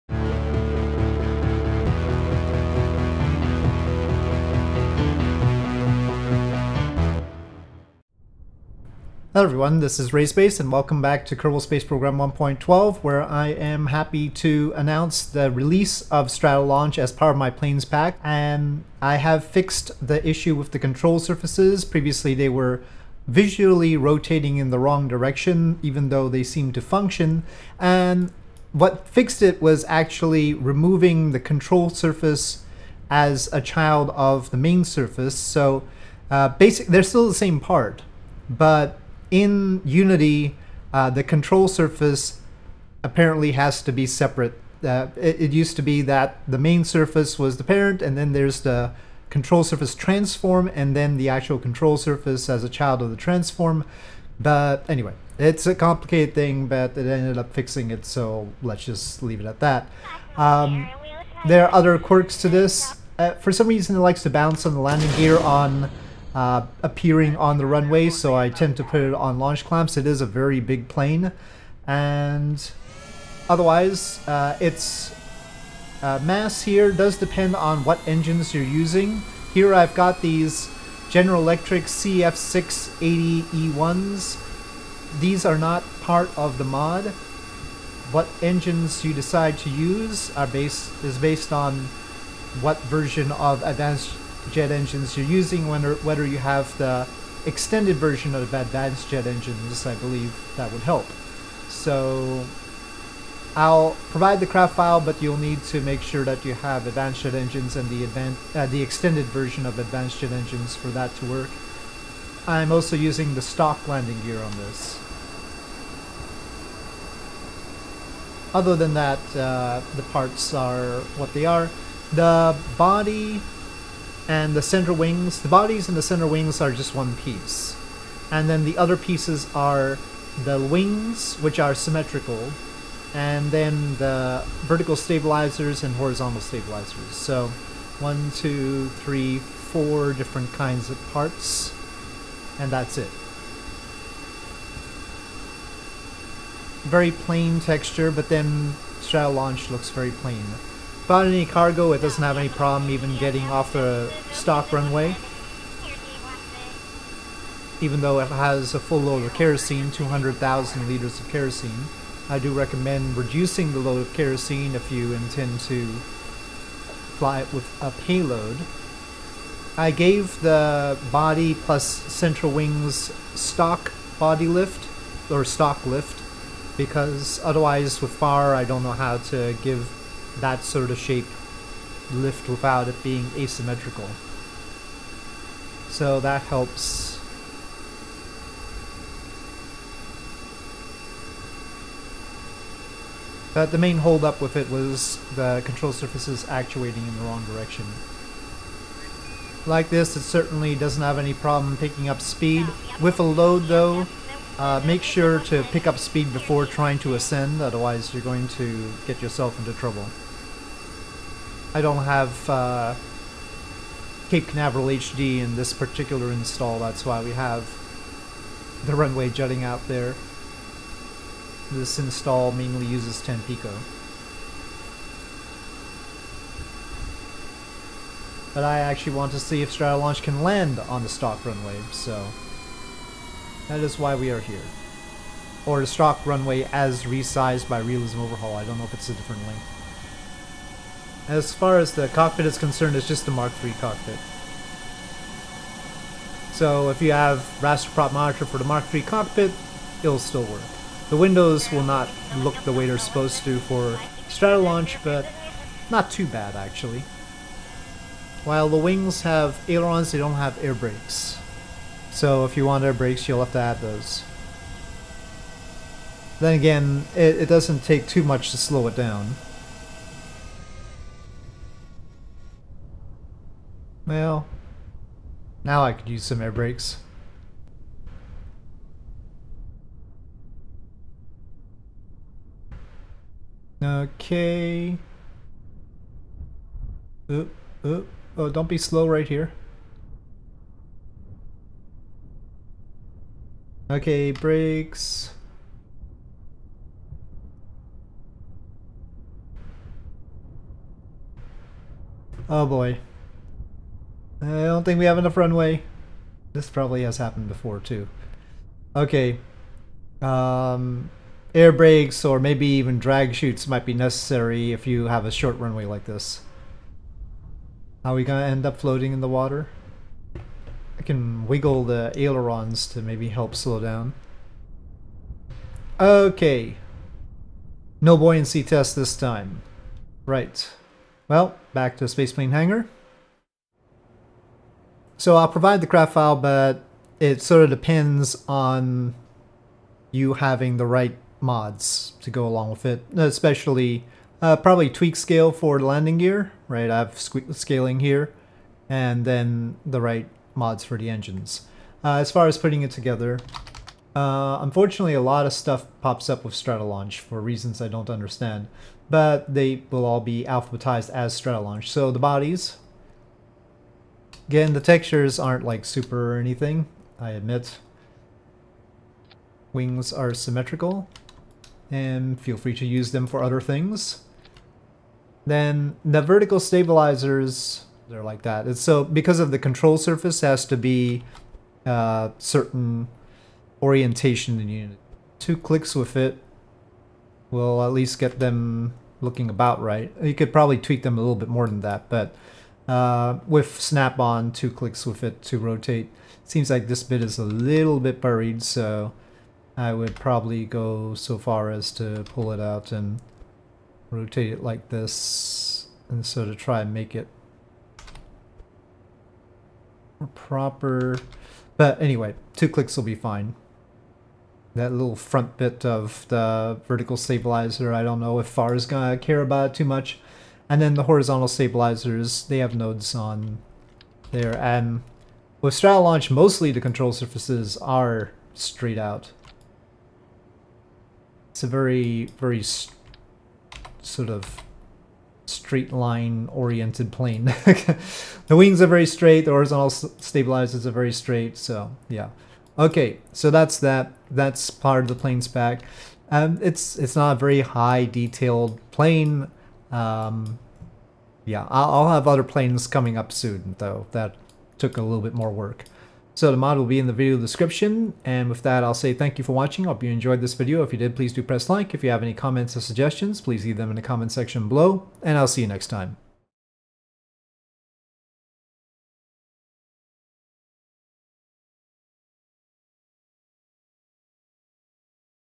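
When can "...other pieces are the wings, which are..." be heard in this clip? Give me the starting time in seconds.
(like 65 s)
128 s.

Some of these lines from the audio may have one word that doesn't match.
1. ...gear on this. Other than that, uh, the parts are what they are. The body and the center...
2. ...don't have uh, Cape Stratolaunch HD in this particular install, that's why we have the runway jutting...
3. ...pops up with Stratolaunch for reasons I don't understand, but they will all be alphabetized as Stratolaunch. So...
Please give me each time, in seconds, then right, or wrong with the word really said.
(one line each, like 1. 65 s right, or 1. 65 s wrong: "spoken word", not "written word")
1. 114 s right
2. 211 s wrong: "Canaveral", not "Stratolaunch"
3. 356 s right.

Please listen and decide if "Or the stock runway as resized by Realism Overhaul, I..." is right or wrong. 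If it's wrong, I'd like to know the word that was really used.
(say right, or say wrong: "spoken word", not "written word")
right.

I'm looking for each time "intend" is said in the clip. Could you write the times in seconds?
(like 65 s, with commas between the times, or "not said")
165 s.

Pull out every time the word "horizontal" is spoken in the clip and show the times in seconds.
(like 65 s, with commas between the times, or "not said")
135 s, 421 s, 439 s.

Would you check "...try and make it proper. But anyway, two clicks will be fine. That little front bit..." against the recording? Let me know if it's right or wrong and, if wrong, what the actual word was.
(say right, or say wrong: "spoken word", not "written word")
right.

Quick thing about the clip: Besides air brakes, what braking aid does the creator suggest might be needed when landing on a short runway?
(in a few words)
Drag chutes.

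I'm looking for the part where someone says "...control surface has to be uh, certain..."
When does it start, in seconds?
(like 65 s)
379 s.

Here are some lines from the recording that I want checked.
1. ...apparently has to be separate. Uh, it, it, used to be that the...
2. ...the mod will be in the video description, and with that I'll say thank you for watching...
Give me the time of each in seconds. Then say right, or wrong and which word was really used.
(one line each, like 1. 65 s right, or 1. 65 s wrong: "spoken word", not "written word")
1. 43 s right
2. 456 s right.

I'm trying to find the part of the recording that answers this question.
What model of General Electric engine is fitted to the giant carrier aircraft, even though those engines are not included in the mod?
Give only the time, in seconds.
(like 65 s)
81 s.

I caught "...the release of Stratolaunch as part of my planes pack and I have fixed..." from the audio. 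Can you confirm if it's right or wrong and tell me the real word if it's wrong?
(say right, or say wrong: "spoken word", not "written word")
right.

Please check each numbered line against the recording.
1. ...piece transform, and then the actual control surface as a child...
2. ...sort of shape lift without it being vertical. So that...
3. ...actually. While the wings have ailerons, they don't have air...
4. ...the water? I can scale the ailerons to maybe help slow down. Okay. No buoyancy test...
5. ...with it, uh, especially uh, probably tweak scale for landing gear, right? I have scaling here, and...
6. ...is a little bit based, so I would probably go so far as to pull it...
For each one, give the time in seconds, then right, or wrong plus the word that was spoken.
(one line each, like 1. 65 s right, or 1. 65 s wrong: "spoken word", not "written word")
1. 49 s wrong: "surface", not "piece"
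2. 180 s wrong: "asymmetrical", not "vertical"
3. 256 s right
4. 319 s wrong: "wiggle", not "scale"
5. 342 s right
6. 397 s wrong: "buried", not "based".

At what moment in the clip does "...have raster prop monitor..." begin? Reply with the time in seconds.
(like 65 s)
247 s.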